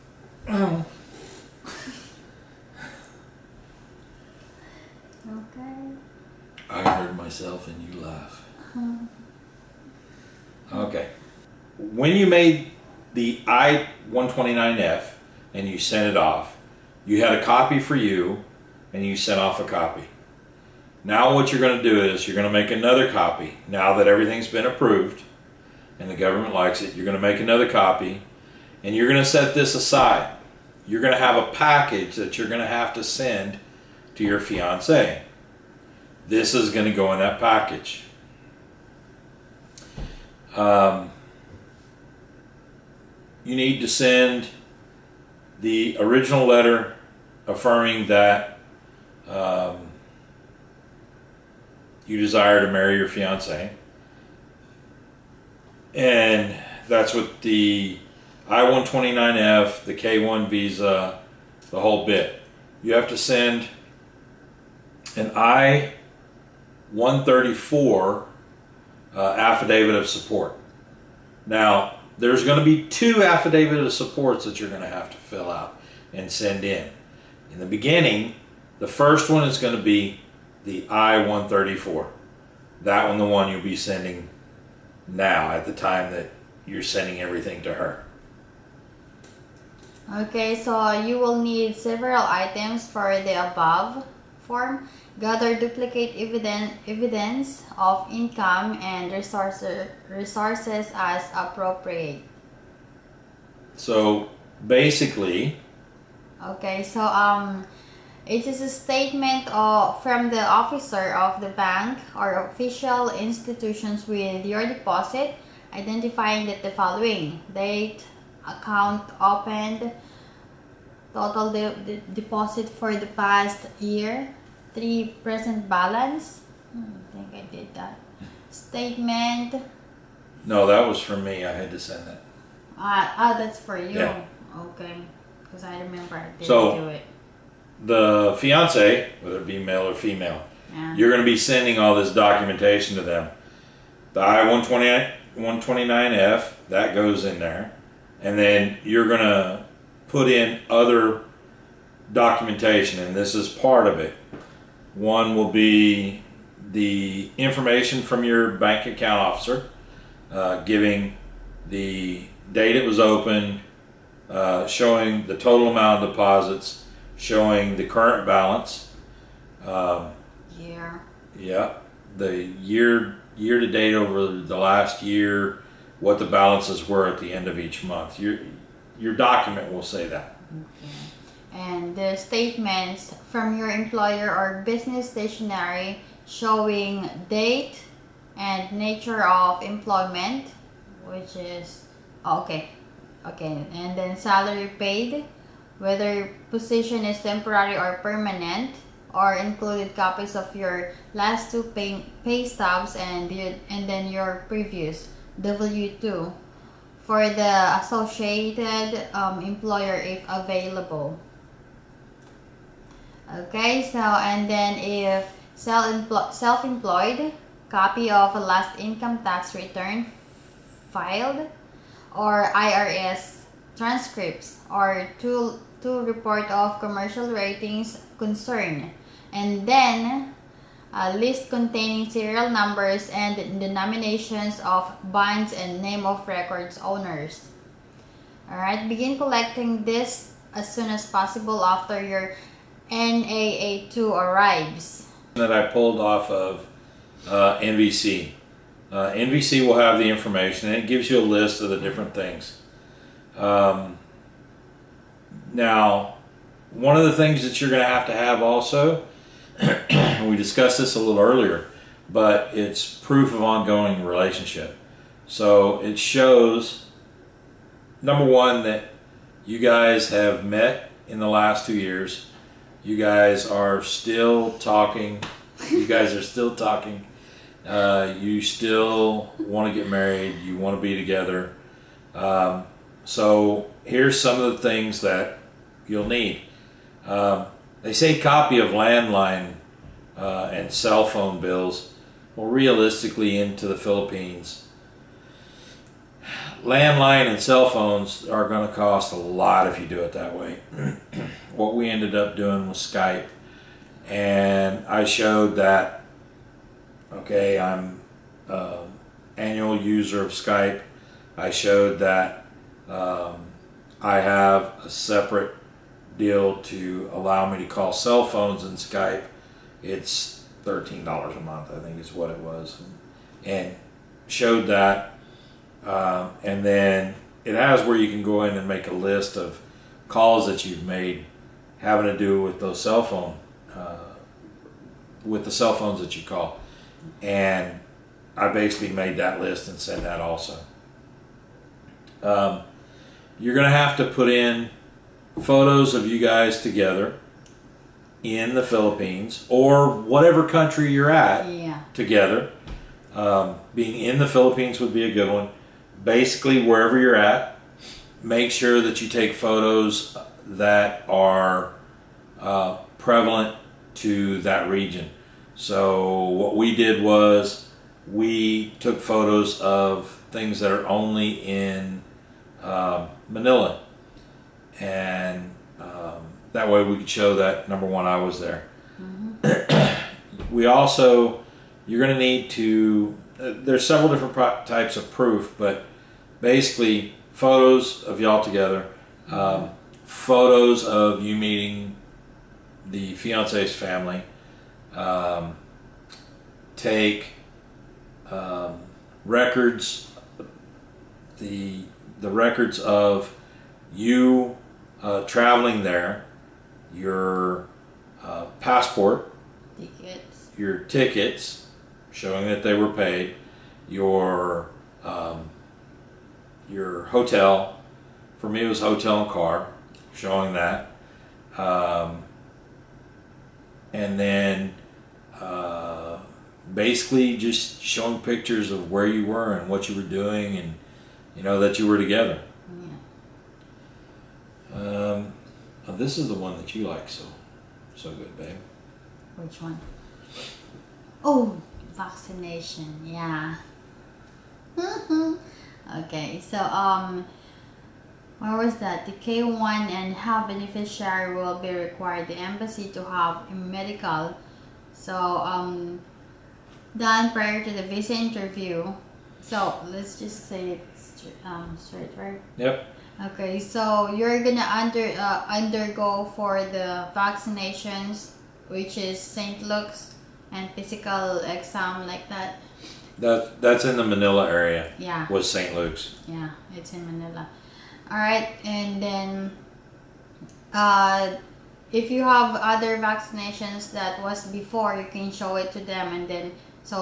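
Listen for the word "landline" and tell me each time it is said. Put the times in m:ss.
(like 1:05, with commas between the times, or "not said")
4:48, 4:56.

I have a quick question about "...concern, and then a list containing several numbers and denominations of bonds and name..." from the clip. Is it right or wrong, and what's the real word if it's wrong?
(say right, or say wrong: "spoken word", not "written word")
wrong: "serial", not "several".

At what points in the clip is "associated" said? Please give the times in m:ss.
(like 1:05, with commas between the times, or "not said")
3:27.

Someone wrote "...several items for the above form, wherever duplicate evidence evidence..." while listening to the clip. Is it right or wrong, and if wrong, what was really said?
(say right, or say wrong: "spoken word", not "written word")
wrong: "gather", not "wherever".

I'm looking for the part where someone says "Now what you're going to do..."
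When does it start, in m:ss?
0:21.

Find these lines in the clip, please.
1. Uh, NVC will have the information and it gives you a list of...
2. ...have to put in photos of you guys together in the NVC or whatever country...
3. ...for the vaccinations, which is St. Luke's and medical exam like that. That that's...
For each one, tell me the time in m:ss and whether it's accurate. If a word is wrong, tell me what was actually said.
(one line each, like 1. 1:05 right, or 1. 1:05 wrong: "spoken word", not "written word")
1. 4:08 right
2. 5:43 wrong: "Philippines", not "NVC"
3. 7:46 wrong: "physical", not "medical".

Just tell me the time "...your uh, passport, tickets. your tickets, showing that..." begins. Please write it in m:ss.
6:46.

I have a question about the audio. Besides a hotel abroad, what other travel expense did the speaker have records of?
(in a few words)
car.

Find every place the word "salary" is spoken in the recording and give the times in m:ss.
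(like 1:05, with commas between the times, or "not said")
3:14.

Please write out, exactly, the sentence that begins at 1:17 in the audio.
In the beginning, the first one is going to be the I-134.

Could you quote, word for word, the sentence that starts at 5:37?
And I basically made that list and sent that also.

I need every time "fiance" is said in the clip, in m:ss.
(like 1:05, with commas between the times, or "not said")
0:34, 0:53, 2:18, 6:33.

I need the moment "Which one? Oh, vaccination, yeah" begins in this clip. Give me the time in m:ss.
7:19.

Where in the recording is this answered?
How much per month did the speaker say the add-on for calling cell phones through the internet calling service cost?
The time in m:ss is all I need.
5:20.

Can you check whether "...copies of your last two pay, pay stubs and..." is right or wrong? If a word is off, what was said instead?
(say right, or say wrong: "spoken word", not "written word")
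right.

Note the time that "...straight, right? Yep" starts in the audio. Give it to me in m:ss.
7:41.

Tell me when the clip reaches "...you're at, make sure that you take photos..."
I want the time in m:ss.
5:56.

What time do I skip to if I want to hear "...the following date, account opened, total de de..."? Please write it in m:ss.
1:56.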